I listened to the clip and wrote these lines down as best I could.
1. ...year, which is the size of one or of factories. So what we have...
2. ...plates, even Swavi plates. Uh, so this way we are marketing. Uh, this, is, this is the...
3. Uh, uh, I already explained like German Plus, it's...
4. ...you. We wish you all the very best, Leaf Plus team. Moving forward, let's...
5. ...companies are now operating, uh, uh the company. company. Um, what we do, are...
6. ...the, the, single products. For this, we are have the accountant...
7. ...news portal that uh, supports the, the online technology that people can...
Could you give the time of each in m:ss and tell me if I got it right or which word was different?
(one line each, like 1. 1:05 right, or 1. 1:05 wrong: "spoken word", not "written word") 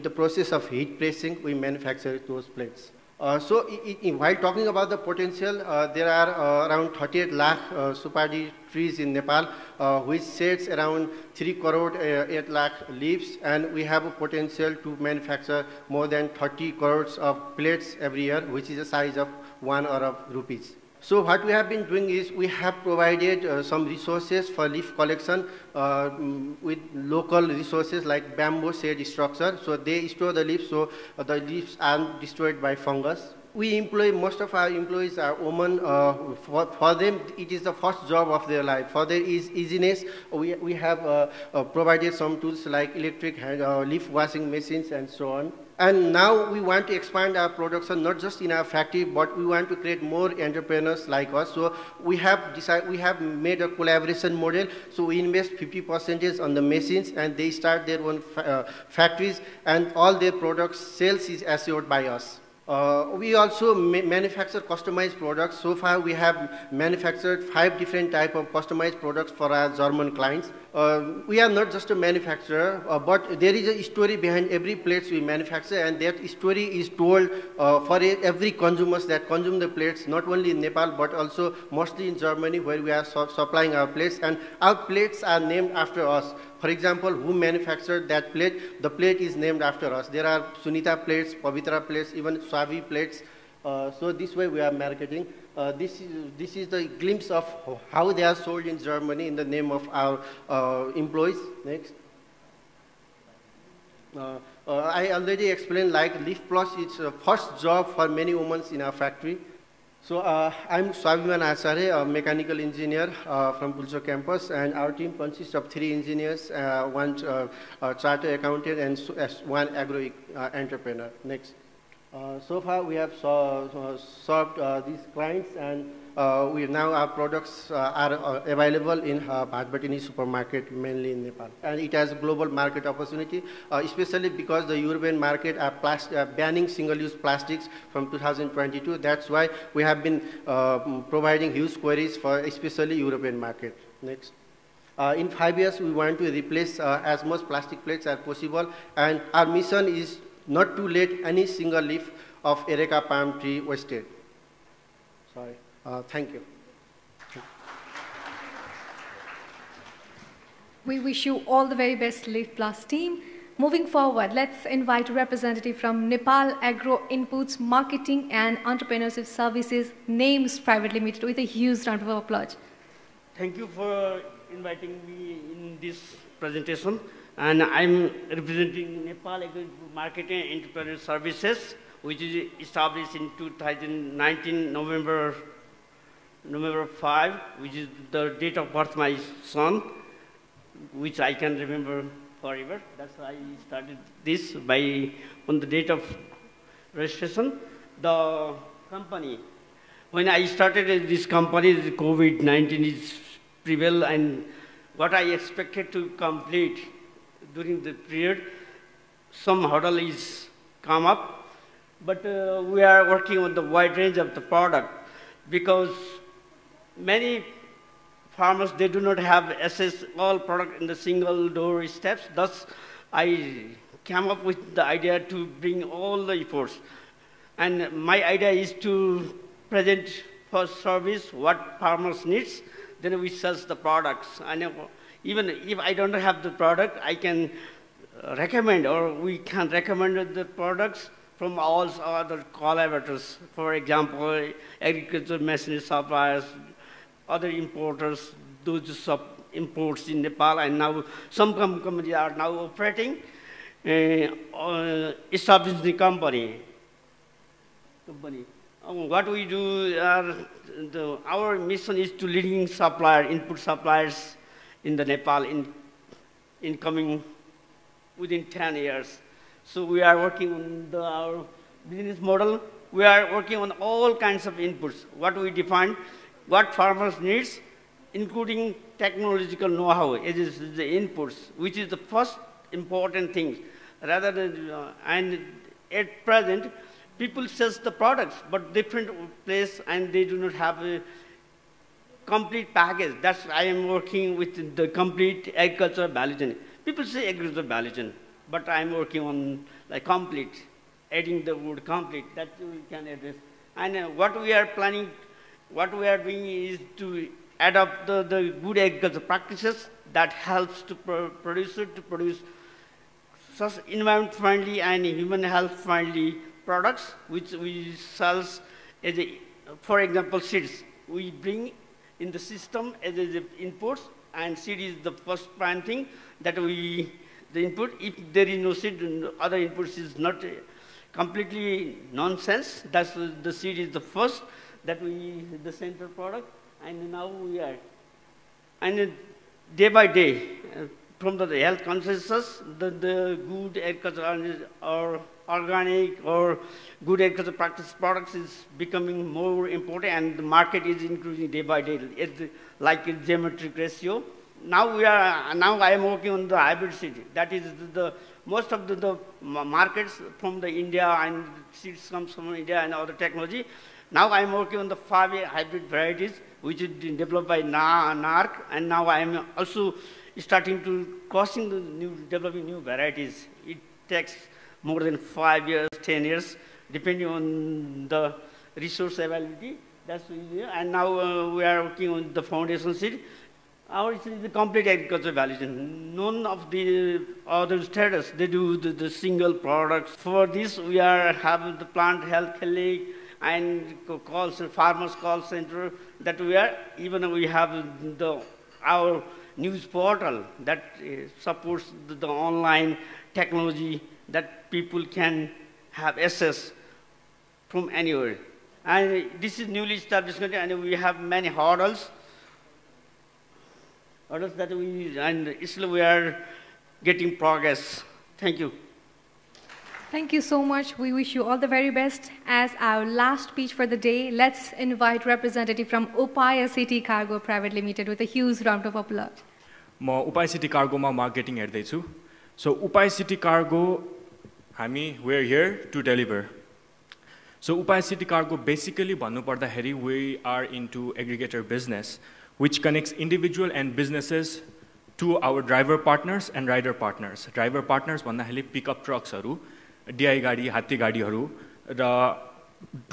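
1. 0:18 wrong: "rupees", not "factories"
2. 1:31 right
3. 1:44 wrong: "Leaf", not "German"
4. 2:36 right
5. 4:11 right
6. 6:28 wrong: "plant", not "accountant"
7. 6:39 right.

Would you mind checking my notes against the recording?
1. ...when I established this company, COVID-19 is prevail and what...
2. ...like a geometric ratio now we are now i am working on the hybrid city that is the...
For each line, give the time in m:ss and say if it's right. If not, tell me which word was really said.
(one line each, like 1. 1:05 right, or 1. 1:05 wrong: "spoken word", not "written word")
1. 3:20 wrong: "started", not "established"
2. 5:52 right.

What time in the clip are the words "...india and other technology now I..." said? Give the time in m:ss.
6:02.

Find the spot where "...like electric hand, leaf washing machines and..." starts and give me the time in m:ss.
0:42.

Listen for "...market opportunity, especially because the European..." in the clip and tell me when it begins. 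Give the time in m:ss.
2:12.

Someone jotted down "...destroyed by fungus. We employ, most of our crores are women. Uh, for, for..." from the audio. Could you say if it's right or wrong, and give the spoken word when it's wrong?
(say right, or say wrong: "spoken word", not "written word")
wrong: "employees", not "crores".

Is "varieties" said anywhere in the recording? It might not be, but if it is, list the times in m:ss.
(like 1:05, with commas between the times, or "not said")
6:05, 6:12.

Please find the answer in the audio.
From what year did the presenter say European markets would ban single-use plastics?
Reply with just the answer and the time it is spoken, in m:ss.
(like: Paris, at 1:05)
2022, at 2:18.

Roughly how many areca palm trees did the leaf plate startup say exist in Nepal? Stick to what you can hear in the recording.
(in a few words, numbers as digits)
38 lakh.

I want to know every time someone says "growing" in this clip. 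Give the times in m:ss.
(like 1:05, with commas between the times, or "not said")
not said.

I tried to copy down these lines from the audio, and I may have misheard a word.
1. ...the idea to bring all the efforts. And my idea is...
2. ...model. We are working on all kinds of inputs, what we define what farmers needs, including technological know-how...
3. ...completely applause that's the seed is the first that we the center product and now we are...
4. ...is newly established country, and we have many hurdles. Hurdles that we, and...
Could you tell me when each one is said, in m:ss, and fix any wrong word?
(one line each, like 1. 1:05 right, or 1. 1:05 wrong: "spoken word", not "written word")
1. 3:44 right
2. 4:32 right
3. 5:31 wrong: "nonsense", not "applause"
4. 6:49 right.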